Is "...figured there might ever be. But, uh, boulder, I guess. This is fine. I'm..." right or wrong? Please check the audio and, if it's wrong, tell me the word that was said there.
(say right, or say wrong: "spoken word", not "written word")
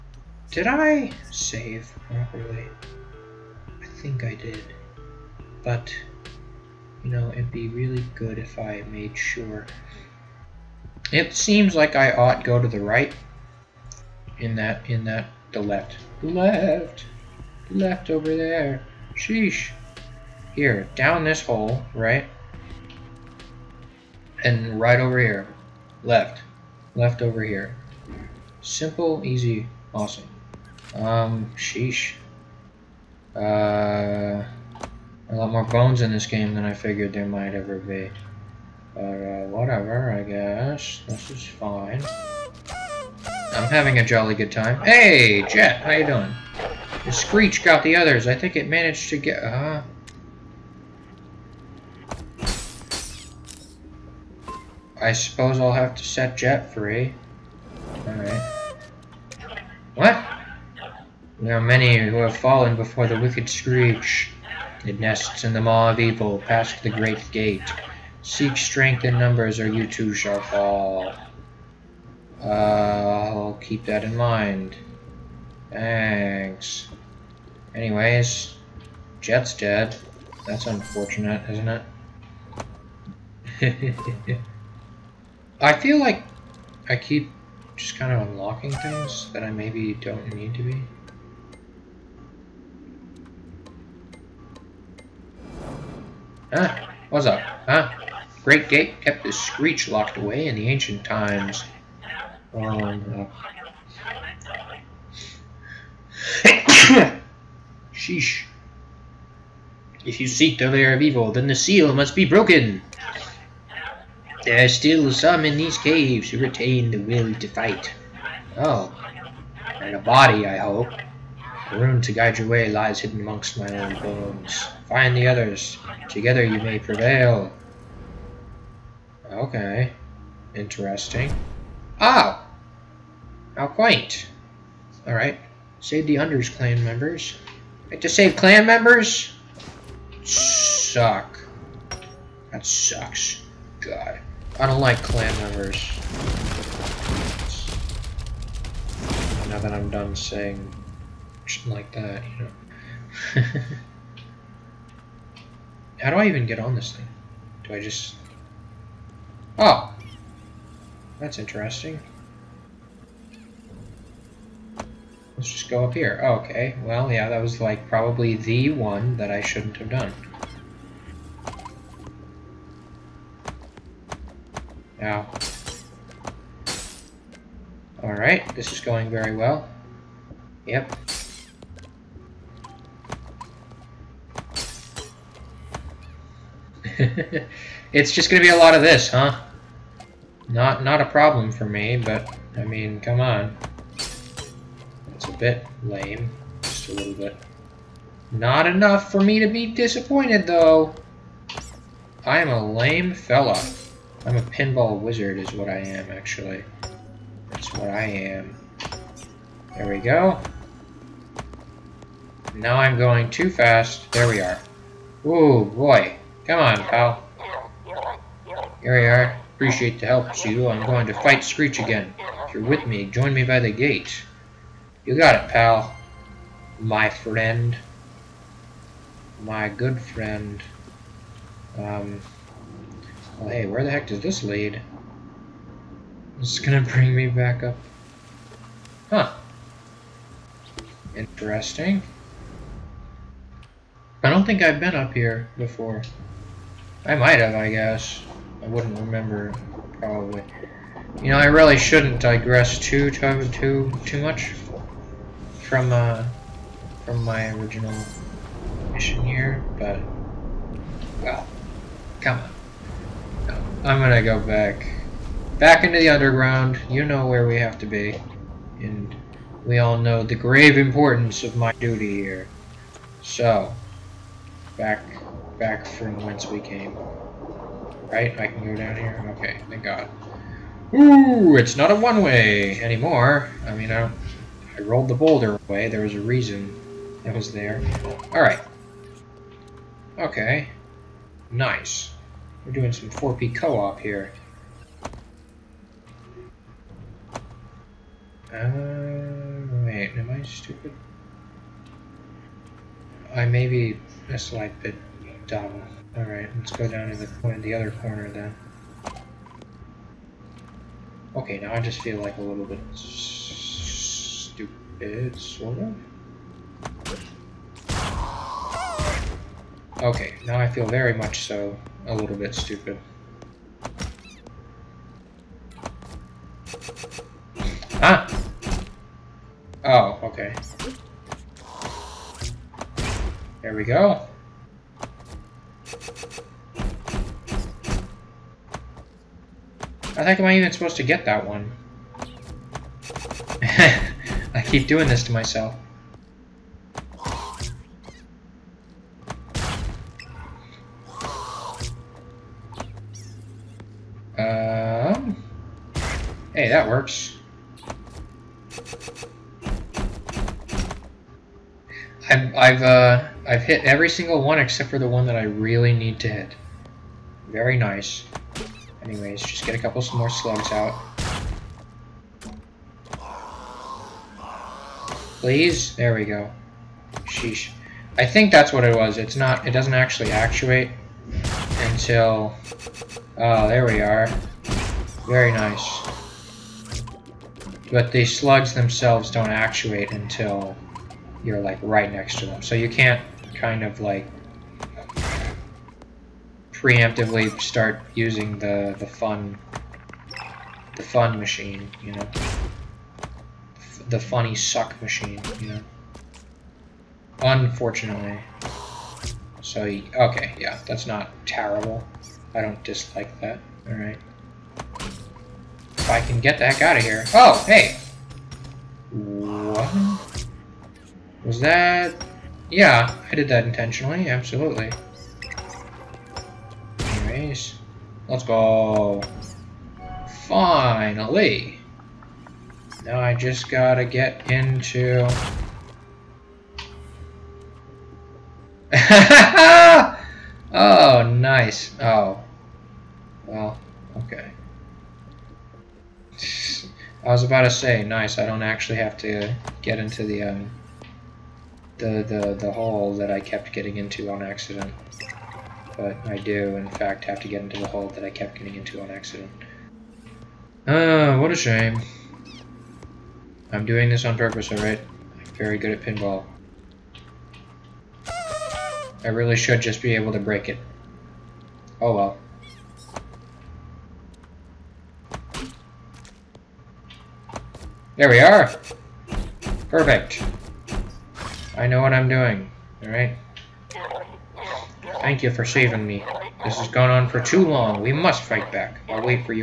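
wrong: "whatever", not "boulder".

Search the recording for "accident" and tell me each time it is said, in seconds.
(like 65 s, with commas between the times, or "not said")
454 s, 459 s.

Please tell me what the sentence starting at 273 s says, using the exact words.
So, back, back from whence we came.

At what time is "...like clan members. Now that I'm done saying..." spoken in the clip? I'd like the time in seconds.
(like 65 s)
144 s.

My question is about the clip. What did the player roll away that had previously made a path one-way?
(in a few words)
the boulder.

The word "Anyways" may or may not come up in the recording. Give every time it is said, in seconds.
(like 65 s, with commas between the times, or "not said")
77 s, 369 s, 427 s.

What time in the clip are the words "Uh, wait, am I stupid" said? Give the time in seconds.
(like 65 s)
298 s.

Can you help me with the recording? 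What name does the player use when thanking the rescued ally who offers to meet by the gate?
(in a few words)
Cheeto.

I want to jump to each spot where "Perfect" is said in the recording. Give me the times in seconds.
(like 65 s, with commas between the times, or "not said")
479 s.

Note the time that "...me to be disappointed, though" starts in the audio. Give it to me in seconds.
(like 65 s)
199 s.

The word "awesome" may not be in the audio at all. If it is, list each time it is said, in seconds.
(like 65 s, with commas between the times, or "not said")
29 s.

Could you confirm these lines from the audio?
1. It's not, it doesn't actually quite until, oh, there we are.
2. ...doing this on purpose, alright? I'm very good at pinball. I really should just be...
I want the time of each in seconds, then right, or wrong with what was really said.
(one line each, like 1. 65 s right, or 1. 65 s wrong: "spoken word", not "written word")
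1. 379 s wrong: "actuate", not "quite"
2. 463 s right.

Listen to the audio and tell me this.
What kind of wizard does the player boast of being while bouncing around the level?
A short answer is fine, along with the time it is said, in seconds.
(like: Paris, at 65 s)
pinball wizard, at 204 s.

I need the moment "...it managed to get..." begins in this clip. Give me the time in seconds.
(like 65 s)
48 s.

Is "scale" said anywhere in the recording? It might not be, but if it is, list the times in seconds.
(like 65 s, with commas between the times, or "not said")
not said.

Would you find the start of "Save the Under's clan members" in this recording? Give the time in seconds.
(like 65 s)
135 s.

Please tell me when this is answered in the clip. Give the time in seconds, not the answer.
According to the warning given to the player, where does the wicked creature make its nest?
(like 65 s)
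65 s.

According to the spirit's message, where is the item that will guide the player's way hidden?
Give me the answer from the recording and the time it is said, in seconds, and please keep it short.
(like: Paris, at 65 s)
amongst my own bones, at 123 s.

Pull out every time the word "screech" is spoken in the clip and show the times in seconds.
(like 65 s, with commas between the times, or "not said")
47 s, 63 s, 99 s, 221 s.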